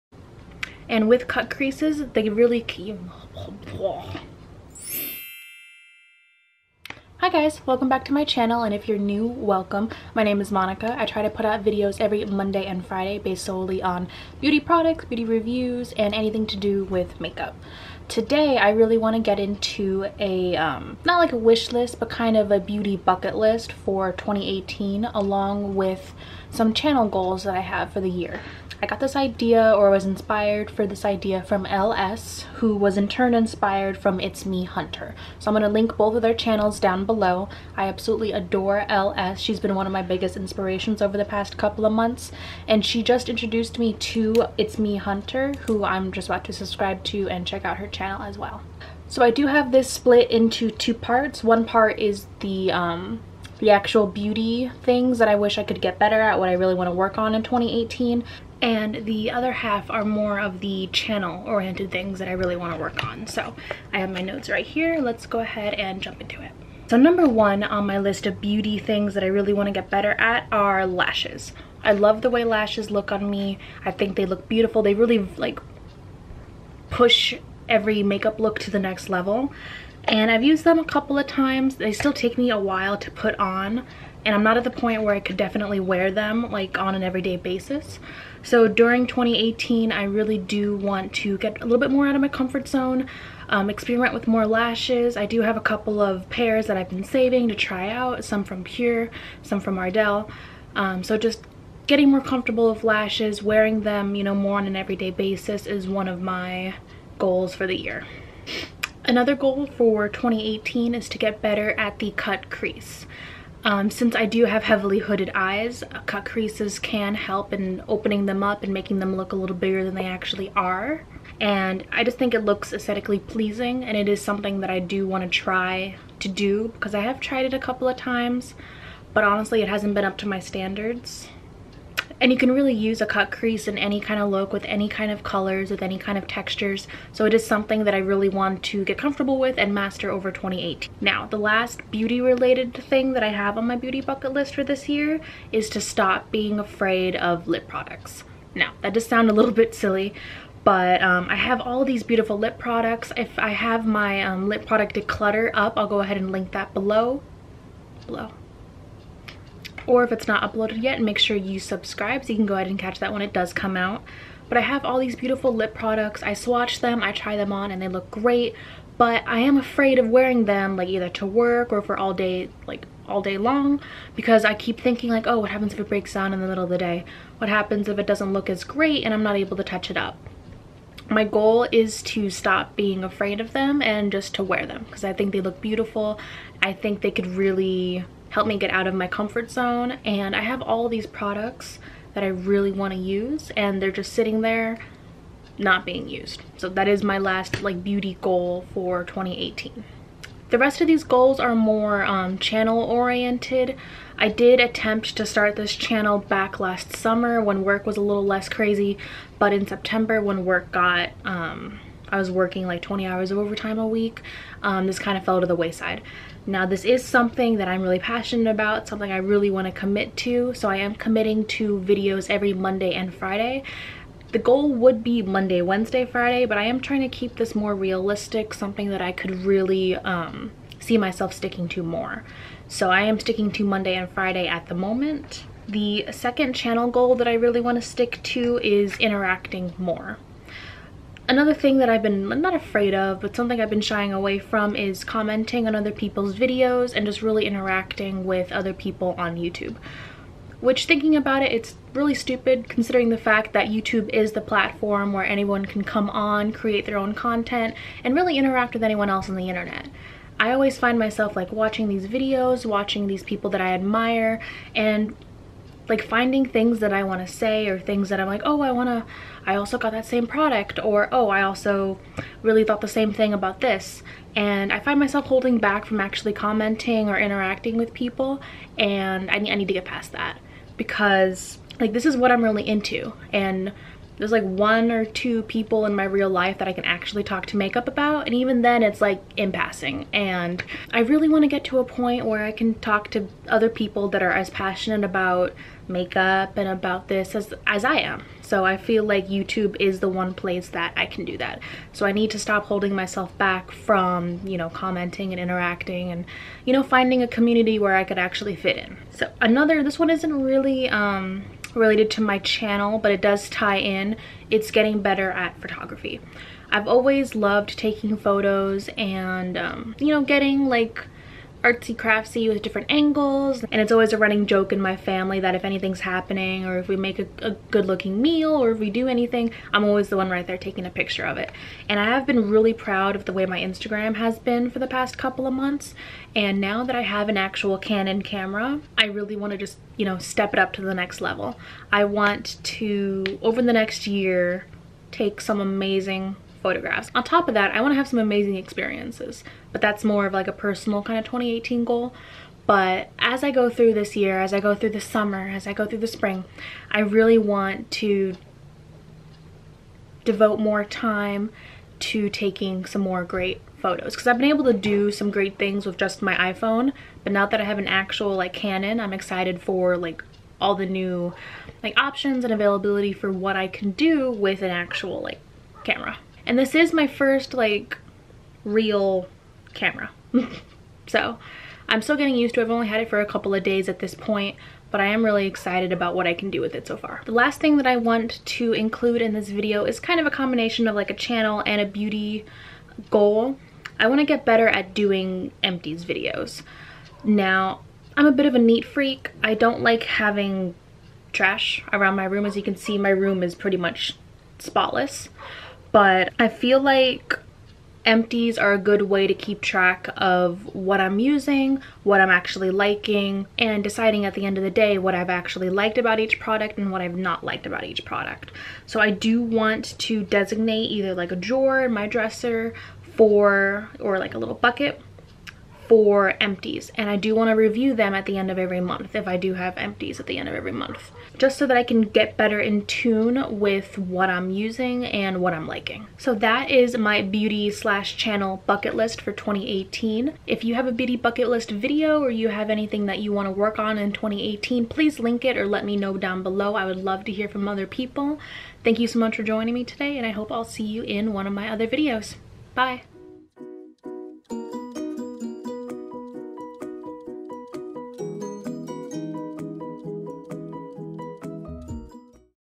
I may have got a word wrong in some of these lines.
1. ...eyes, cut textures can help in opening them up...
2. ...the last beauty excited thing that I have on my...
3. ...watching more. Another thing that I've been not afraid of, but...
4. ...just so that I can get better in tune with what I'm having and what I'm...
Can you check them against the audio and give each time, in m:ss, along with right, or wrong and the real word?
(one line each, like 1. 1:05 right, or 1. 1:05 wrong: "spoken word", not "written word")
1. 1:55 wrong: "creases", not "textures"
2. 2:21 wrong: "related", not "excited"
3. 3:58 wrong: "interacting", not "watching"
4. 7:11 wrong: "using", not "having".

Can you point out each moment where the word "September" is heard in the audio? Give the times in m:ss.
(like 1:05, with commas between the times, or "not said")
3:29.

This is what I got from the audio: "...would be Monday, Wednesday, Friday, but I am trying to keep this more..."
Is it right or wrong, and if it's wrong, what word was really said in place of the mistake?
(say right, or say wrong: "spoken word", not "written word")
right.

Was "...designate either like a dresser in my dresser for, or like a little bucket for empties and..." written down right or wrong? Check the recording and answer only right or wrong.
wrong.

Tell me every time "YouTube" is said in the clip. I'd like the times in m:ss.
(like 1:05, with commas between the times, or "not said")
4:09, 4:13, 4:59.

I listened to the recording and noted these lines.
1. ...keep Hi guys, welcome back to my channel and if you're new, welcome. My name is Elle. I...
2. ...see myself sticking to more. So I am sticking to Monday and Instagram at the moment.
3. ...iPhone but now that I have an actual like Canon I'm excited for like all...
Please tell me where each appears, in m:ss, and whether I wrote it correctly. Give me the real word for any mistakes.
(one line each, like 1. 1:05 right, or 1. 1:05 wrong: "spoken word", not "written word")
1. 0:02 wrong: "Monica", not "Elle"
2. 3:50 wrong: "Friday", not "Instagram"
3. 6:06 right.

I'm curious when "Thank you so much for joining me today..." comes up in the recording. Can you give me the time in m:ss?
7:28.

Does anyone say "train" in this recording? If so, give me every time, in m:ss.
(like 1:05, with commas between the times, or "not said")
not said.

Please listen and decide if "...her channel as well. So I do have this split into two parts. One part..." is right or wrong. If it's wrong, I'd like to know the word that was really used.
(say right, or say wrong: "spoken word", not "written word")
right.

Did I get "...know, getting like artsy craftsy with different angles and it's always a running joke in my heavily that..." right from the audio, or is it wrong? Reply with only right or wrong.
wrong.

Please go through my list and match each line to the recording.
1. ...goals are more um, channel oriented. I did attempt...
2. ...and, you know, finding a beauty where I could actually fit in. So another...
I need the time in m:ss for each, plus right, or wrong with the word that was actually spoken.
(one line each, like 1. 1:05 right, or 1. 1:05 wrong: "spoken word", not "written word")
1. 3:21 right
2. 5:06 wrong: "community", not "beauty".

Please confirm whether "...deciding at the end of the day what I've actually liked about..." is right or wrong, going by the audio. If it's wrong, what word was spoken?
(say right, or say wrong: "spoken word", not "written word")
right.